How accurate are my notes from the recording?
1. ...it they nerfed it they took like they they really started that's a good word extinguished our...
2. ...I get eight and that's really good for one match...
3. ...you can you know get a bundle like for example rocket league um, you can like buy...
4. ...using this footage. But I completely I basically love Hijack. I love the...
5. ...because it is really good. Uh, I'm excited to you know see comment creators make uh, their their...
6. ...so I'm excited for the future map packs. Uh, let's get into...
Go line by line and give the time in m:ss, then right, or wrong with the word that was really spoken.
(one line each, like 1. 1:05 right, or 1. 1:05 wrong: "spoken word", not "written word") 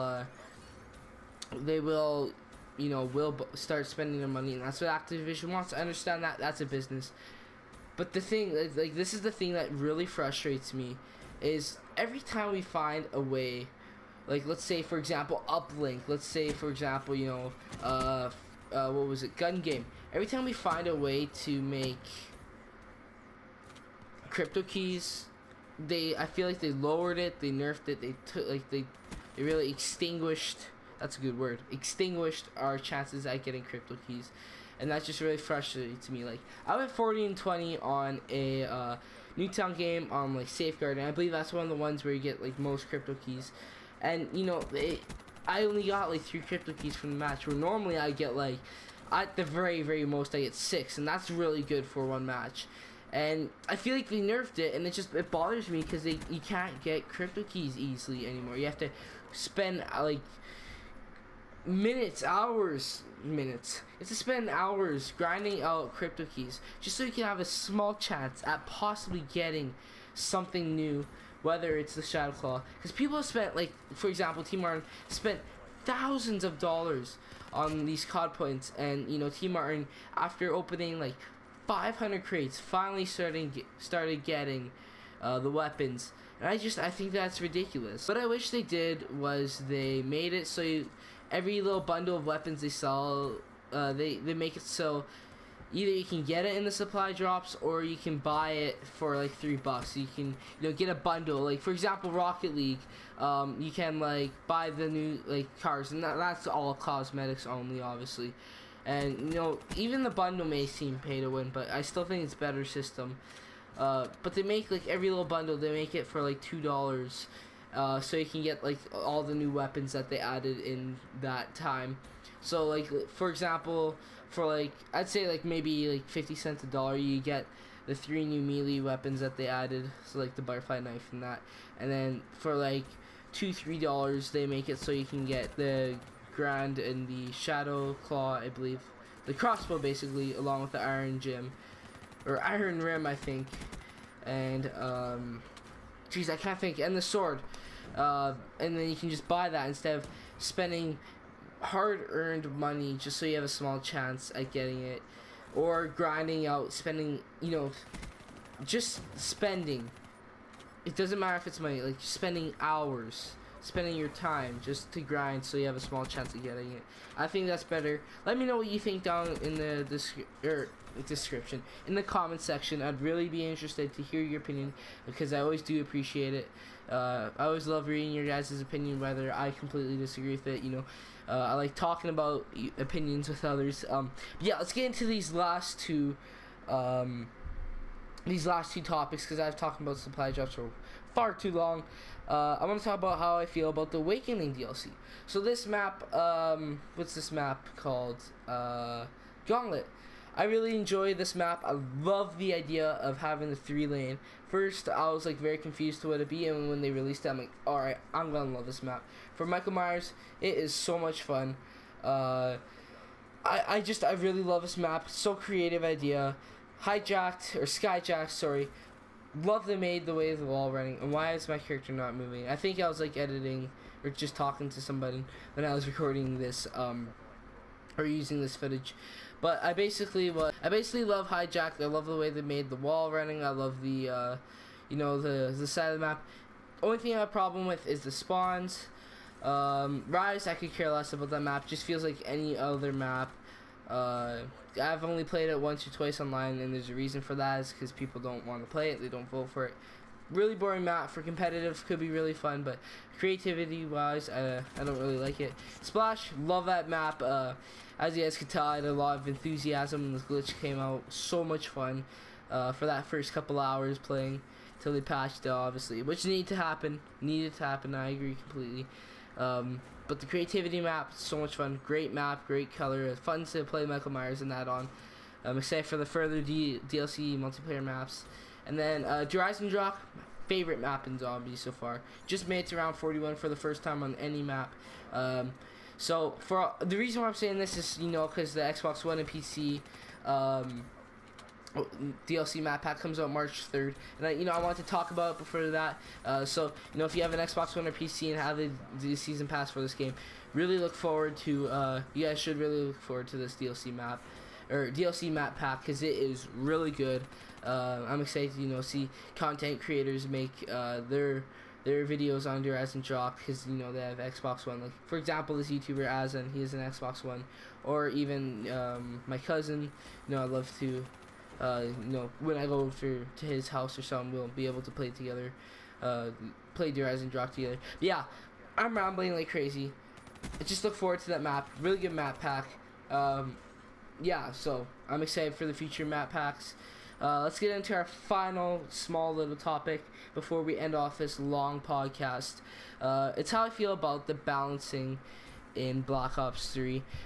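1. 0:27 wrong: "extinguished", not "started"
2. 0:50 wrong: "six", not "eight"
3. 1:39 right
4. 3:48 wrong: "basically", not "completely"
5. 5:05 wrong: "content", not "comment"
6. 5:34 right.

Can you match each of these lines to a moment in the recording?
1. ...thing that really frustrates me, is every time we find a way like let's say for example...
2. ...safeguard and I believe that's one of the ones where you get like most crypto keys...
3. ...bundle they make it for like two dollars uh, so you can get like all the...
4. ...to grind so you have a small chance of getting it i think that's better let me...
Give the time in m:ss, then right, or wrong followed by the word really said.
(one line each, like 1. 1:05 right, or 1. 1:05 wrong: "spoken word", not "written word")
1. 0:09 right
2. 0:40 right
3. 1:55 right
4. 2:44 right.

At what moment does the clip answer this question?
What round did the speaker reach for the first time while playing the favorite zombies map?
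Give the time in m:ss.
4:42.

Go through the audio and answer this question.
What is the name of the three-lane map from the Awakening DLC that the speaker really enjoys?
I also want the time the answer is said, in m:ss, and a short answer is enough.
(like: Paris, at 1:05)
Gauntlet, at 3:19.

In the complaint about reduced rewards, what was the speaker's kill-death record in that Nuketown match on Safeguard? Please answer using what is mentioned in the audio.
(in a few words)
40 and 20.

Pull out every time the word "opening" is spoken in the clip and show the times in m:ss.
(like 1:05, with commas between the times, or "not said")
1:20.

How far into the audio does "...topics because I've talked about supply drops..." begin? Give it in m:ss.
3:08.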